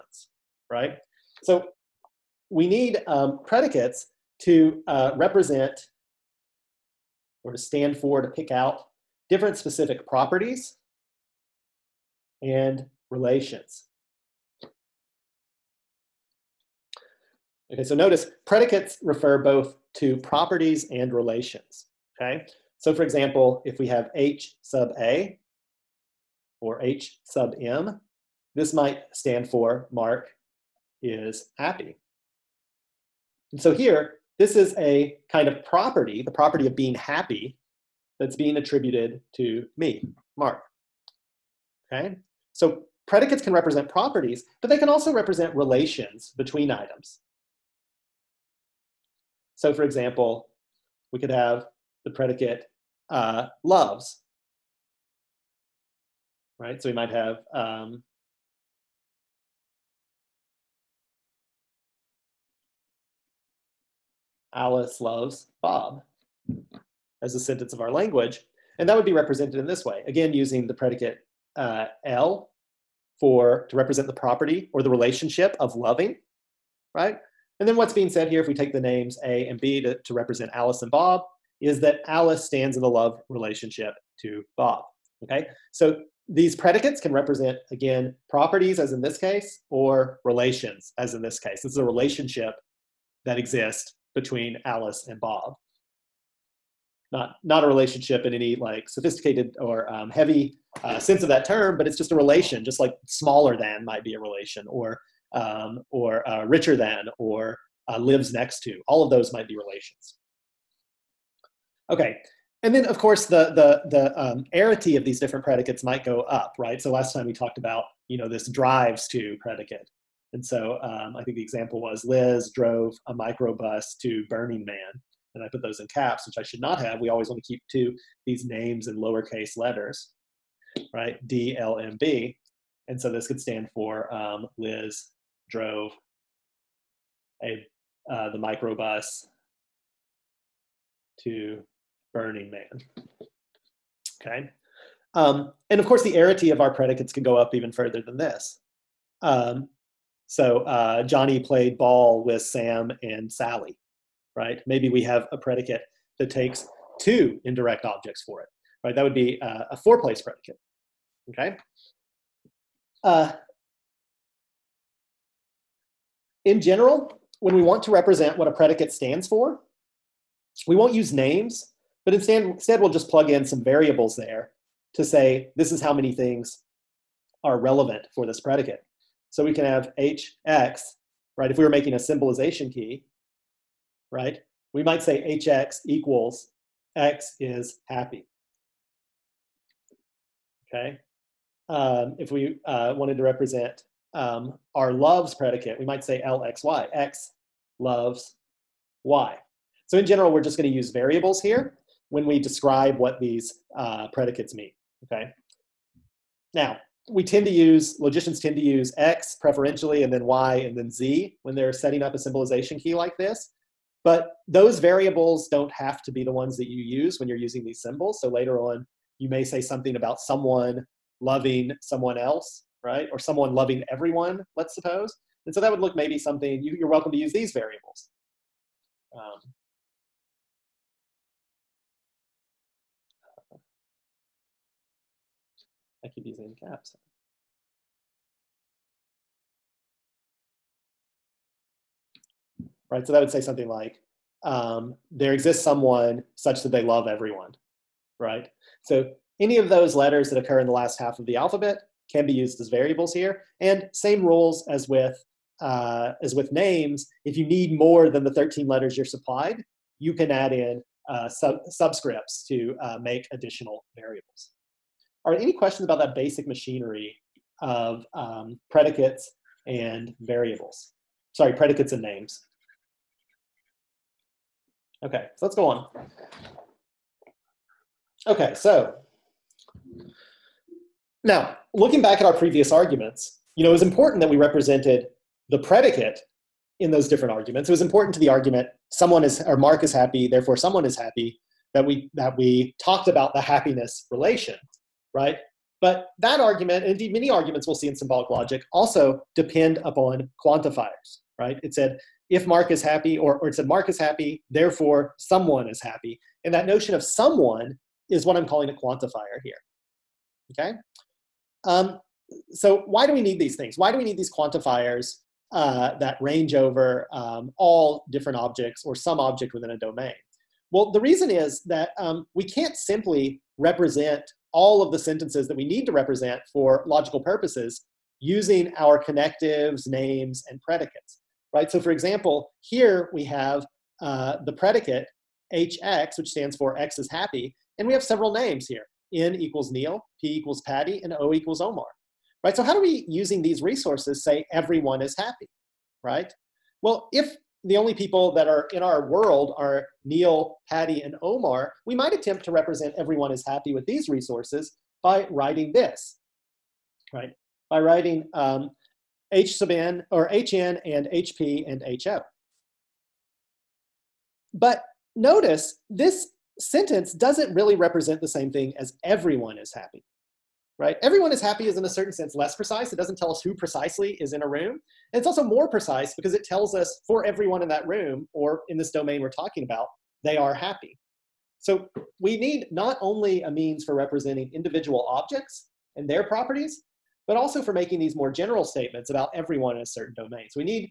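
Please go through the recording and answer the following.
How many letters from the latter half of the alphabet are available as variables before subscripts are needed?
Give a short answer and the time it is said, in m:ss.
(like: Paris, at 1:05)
13, at 4:18.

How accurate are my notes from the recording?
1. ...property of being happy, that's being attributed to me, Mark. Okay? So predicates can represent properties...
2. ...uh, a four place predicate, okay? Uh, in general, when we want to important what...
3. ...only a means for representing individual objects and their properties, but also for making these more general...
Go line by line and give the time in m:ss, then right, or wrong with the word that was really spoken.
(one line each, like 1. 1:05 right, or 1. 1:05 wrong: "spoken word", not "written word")
1. 0:36 right
2. 2:39 wrong: "represent", not "important"
3. 6:22 right.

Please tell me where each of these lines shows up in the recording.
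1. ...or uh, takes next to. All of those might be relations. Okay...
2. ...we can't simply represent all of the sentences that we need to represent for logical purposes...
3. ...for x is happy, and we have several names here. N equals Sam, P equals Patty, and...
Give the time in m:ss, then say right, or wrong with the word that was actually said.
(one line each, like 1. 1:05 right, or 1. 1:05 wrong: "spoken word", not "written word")
1. 1:47 wrong: "lives", not "takes"
2. 5:22 right
3. 5:36 wrong: "Neil", not "Sam".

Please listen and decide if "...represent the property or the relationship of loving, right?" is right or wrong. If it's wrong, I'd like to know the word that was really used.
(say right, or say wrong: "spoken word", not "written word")
right.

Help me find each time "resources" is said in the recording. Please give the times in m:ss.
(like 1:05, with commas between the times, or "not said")
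5:43, 5:54.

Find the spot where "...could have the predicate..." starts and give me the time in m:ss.
0:51.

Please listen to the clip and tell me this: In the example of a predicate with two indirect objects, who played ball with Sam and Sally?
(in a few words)
Johnny.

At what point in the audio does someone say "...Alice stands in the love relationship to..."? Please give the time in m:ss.
1:22.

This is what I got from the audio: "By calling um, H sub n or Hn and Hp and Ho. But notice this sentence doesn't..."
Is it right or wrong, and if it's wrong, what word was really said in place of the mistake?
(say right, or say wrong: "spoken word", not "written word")
wrong: "writing", not "calling".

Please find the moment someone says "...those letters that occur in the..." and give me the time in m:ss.
4:09.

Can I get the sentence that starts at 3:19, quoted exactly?
So in general, we're just going to use variables here when we describe what these uh, predicates mean.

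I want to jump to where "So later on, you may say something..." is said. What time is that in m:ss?
3:38.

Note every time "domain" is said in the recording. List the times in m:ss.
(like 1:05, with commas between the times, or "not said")
5:19, 6:18, 6:30.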